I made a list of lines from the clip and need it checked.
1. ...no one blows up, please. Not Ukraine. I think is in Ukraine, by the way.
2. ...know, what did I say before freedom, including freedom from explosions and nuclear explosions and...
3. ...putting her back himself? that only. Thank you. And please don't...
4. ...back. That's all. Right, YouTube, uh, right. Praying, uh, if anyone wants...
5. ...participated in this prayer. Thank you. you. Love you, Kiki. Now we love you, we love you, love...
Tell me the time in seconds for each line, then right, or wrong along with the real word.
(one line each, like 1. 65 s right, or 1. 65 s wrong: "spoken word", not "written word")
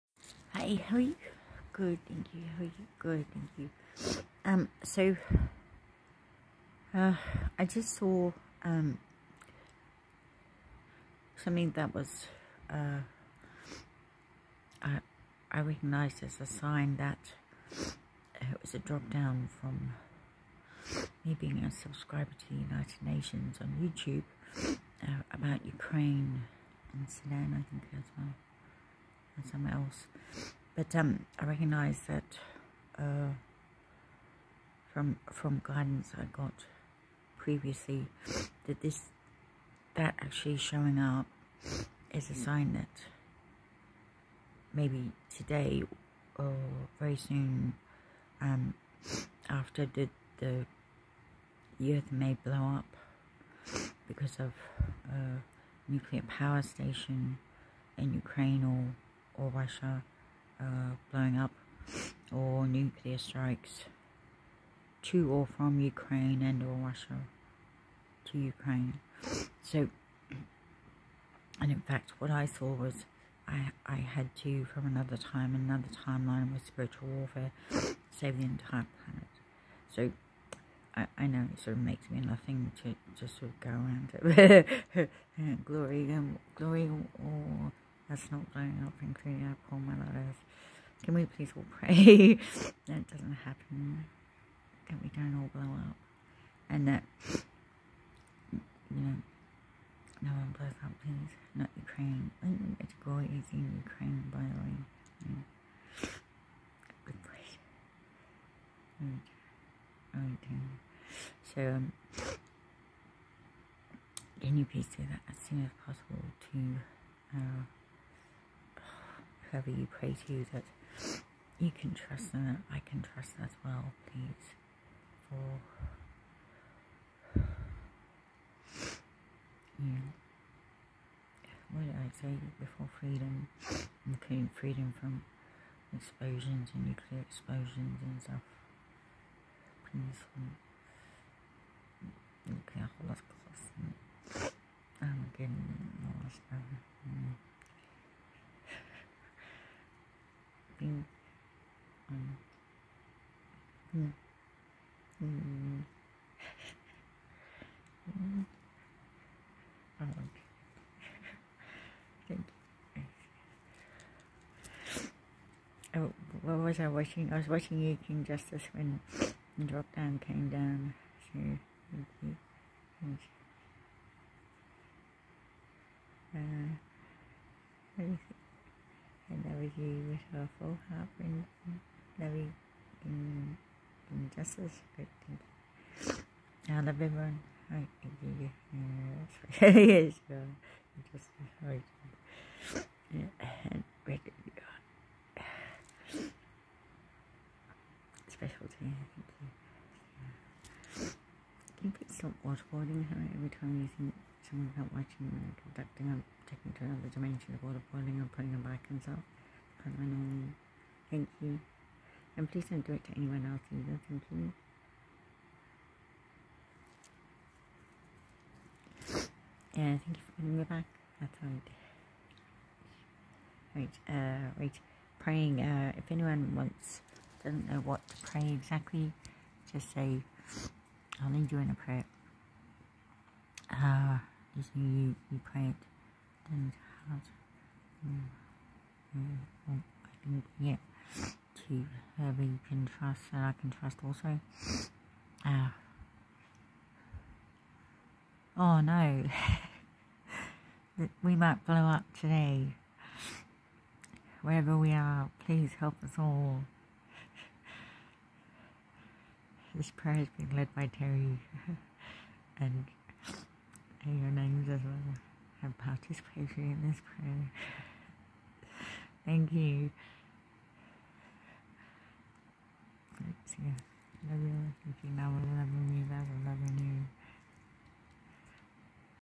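1. 100 s right
2. 129 s right
3. 208 s right
4. 220 s wrong: "Right", not "YouTube"
5. 265 s right.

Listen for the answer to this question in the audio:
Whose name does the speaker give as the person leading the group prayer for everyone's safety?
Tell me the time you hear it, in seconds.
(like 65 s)
260 s.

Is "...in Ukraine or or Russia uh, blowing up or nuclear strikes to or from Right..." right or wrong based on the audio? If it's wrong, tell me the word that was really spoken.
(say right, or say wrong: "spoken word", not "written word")
wrong: "Ukraine", not "Right".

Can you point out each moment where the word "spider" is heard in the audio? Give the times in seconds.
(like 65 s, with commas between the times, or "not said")
not said.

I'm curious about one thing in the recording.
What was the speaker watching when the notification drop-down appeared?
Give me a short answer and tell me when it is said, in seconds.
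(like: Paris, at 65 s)
King Justice, at 168 s.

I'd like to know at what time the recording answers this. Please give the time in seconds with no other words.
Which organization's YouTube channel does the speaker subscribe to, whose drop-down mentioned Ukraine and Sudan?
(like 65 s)
22 s.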